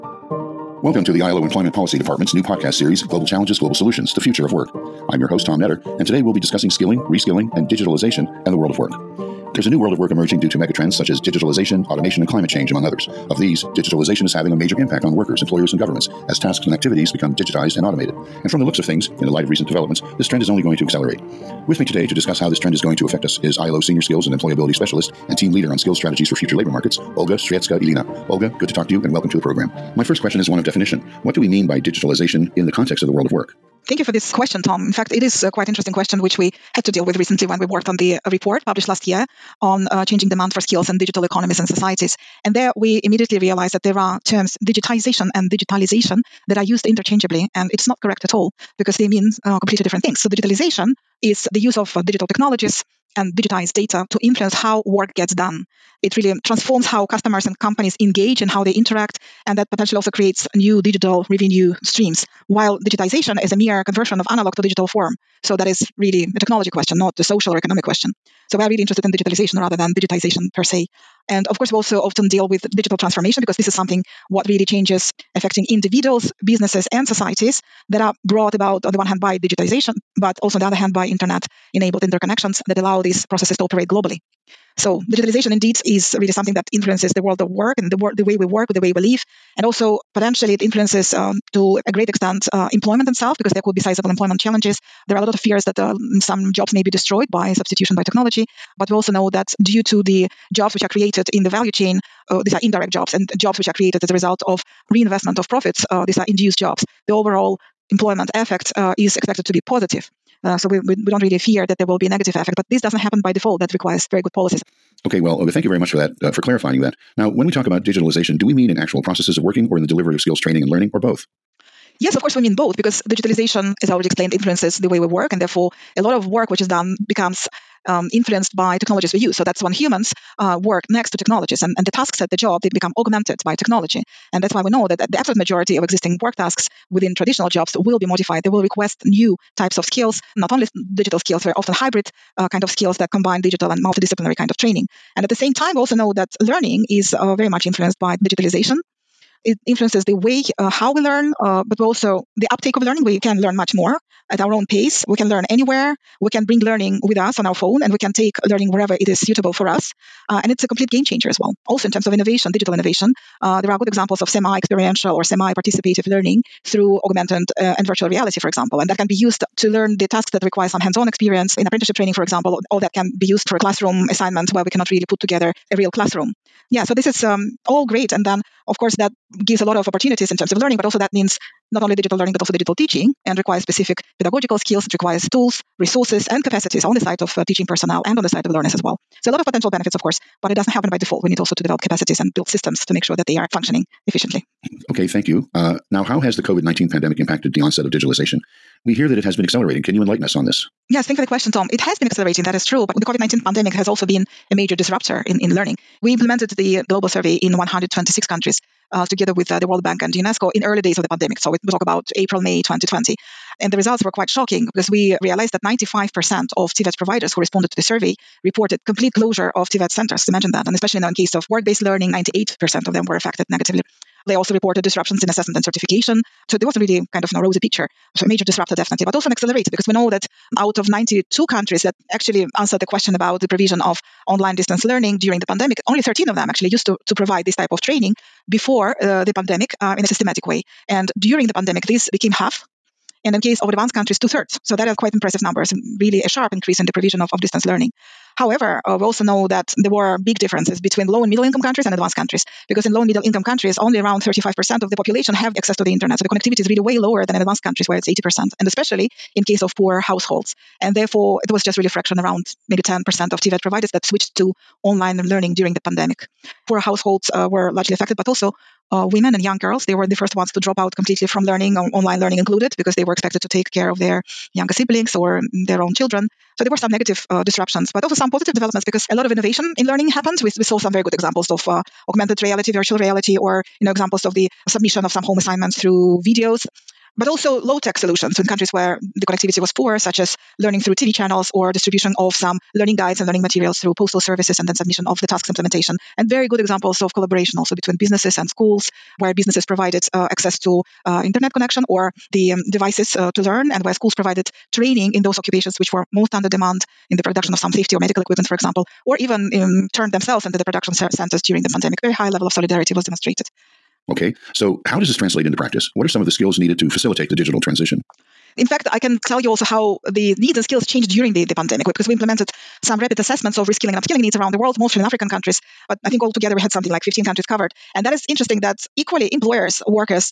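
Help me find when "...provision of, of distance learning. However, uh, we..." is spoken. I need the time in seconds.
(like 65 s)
246 s.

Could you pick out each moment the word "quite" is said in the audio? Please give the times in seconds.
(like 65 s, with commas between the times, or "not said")
35 s, 214 s, 244 s.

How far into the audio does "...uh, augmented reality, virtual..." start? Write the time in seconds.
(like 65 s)
281 s.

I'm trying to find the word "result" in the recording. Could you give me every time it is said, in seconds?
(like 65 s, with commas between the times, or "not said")
104 s, 213 s.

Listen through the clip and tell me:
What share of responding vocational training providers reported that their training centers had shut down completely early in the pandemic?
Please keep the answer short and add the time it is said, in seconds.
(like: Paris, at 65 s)
95%, at 215 s.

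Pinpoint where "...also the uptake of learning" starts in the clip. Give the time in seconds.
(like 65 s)
151 s.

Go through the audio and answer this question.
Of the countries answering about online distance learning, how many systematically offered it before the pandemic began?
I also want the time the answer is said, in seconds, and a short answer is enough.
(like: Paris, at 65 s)
13, at 236 s.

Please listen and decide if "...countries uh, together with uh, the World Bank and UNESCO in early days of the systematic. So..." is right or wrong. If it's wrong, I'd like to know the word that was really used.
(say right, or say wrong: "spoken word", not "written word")
wrong: "pandemic", not "systematic".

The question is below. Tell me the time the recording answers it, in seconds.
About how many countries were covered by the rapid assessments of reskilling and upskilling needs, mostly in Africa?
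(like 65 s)
327 s.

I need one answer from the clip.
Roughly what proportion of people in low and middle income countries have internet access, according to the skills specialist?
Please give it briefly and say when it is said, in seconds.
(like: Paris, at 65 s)
35%, at 254 s.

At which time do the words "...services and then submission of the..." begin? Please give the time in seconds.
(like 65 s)
294 s.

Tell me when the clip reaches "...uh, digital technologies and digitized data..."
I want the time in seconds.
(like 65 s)
51 s.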